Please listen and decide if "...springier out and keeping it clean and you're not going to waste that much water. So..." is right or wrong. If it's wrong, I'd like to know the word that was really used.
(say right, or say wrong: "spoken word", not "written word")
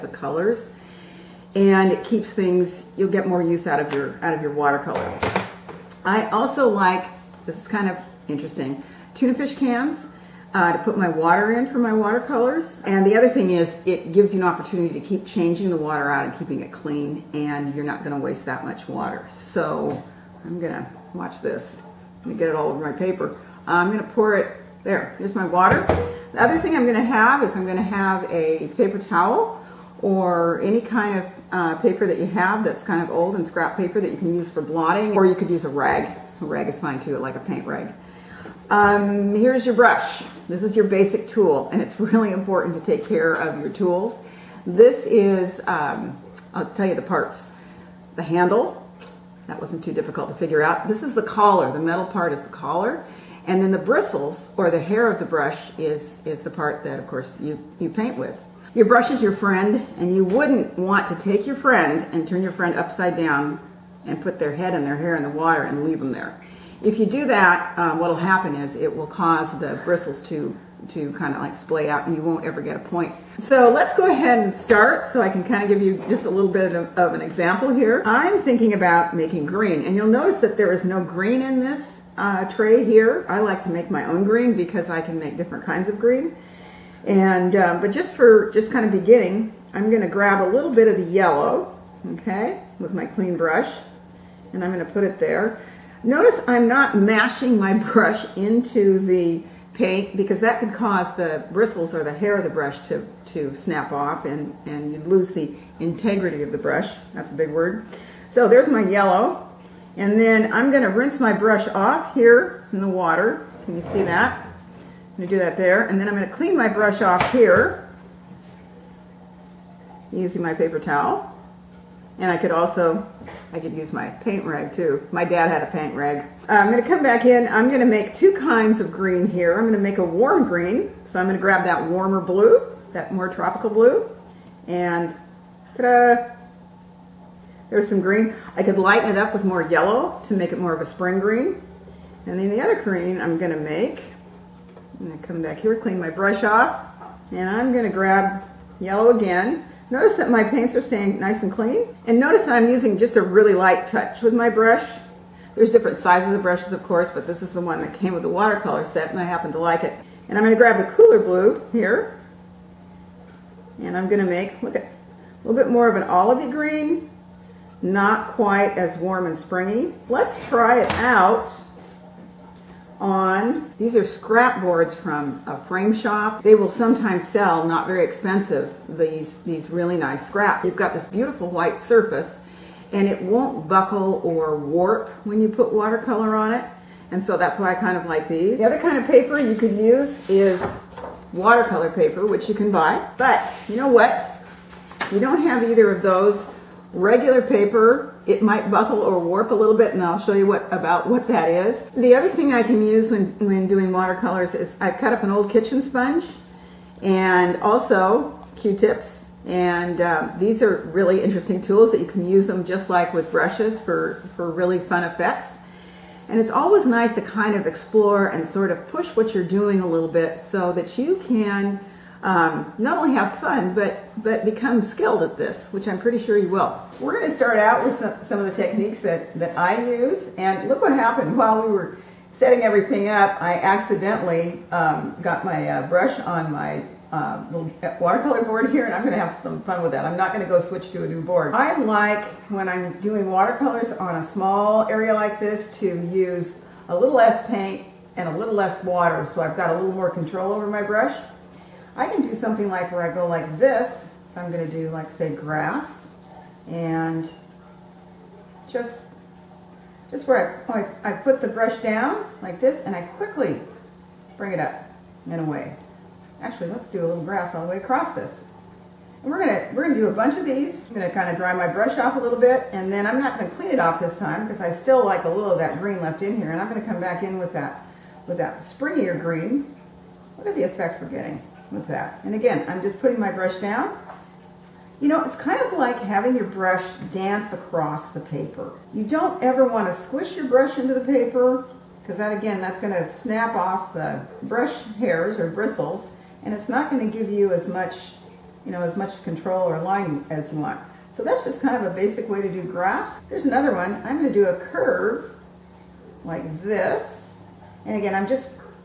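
wrong: "water", not "springier".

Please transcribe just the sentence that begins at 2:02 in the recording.
And I could also I could use my paint rag too.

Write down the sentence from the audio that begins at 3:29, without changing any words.
And um, these are really interesting tools that you can use them just like with brushes for, for really fun effects.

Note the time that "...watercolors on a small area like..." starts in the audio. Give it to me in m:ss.
4:03.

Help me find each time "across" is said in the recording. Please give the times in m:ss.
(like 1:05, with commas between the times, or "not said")
4:27, 4:47.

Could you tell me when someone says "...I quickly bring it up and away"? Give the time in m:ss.
4:22.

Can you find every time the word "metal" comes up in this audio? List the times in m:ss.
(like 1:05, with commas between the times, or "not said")
0:51.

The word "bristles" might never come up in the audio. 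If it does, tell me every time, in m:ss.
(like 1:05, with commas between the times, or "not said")
0:53, 1:09, 1:41, 4:55.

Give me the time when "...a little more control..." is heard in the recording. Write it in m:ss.
4:09.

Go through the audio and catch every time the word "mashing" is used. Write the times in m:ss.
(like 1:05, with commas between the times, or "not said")
1:36.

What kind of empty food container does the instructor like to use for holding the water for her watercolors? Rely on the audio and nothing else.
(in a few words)
tuna fish cans.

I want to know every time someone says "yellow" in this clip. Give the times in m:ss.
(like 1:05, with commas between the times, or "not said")
1:31, 1:48, 2:19, 2:28.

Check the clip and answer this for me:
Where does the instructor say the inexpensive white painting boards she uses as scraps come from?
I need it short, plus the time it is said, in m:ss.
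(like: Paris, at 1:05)
a frame shop, at 2:55.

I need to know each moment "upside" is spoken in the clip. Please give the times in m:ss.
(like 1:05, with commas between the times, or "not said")
1:02.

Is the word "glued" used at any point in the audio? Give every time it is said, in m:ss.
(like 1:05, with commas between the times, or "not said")
not said.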